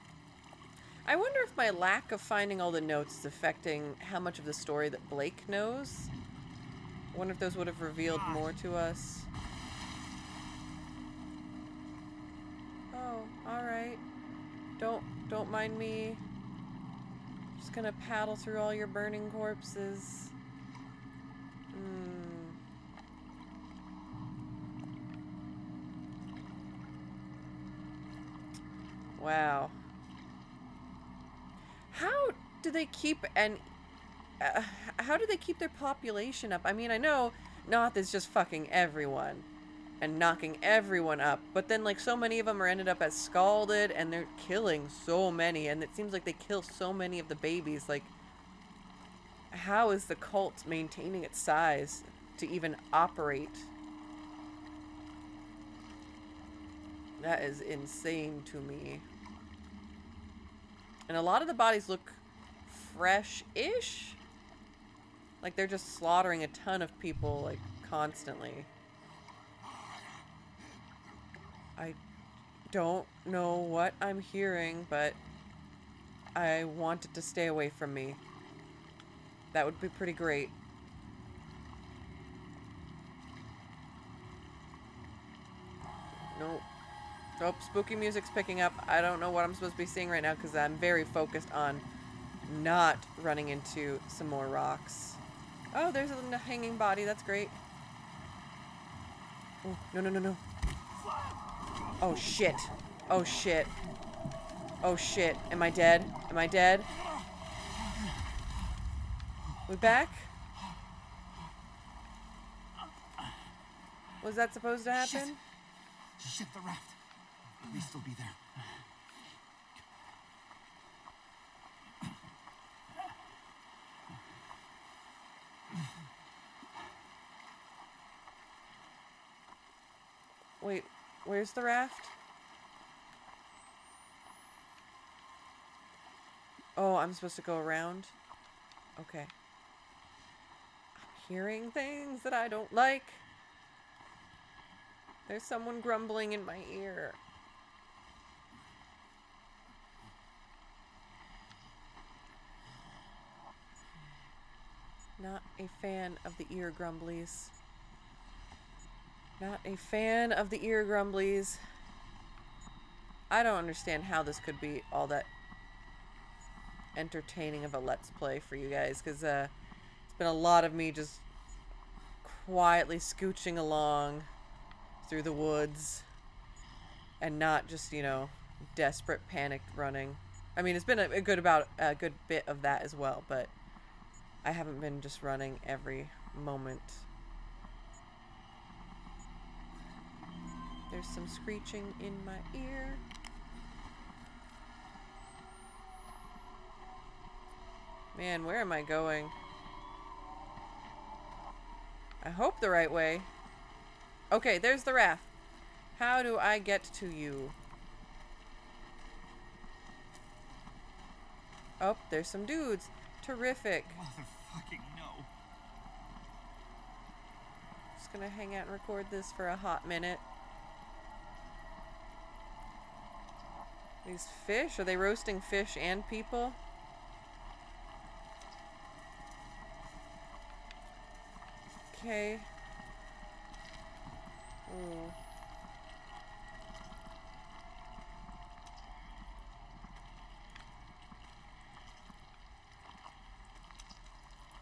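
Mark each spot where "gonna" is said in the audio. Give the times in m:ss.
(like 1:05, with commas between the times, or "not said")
0:17, 3:38.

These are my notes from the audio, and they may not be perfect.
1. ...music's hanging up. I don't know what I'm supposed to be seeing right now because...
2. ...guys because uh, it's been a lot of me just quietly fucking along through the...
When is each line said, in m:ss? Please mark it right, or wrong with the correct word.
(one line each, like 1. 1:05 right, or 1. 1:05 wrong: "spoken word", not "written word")
1. 1:27 wrong: "picking", not "hanging"
2. 2:48 wrong: "scooching", not "fucking".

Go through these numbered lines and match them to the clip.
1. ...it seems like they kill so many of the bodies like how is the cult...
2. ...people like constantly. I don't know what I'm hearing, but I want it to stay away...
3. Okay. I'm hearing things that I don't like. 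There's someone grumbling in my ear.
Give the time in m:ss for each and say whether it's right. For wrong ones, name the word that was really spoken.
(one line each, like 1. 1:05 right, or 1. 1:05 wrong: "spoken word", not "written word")
1. 0:45 wrong: "babies", not "bodies"
2. 1:06 right
3. 2:18 right.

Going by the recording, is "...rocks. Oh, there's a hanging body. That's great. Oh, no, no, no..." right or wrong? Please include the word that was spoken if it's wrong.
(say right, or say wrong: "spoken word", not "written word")
right.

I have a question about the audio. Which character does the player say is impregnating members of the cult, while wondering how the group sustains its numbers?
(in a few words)
Knoth.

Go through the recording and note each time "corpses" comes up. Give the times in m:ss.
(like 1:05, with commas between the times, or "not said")
0:19.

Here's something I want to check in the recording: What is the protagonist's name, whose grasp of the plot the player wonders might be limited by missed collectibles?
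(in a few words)
Blake.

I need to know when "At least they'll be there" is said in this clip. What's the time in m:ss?
1:57.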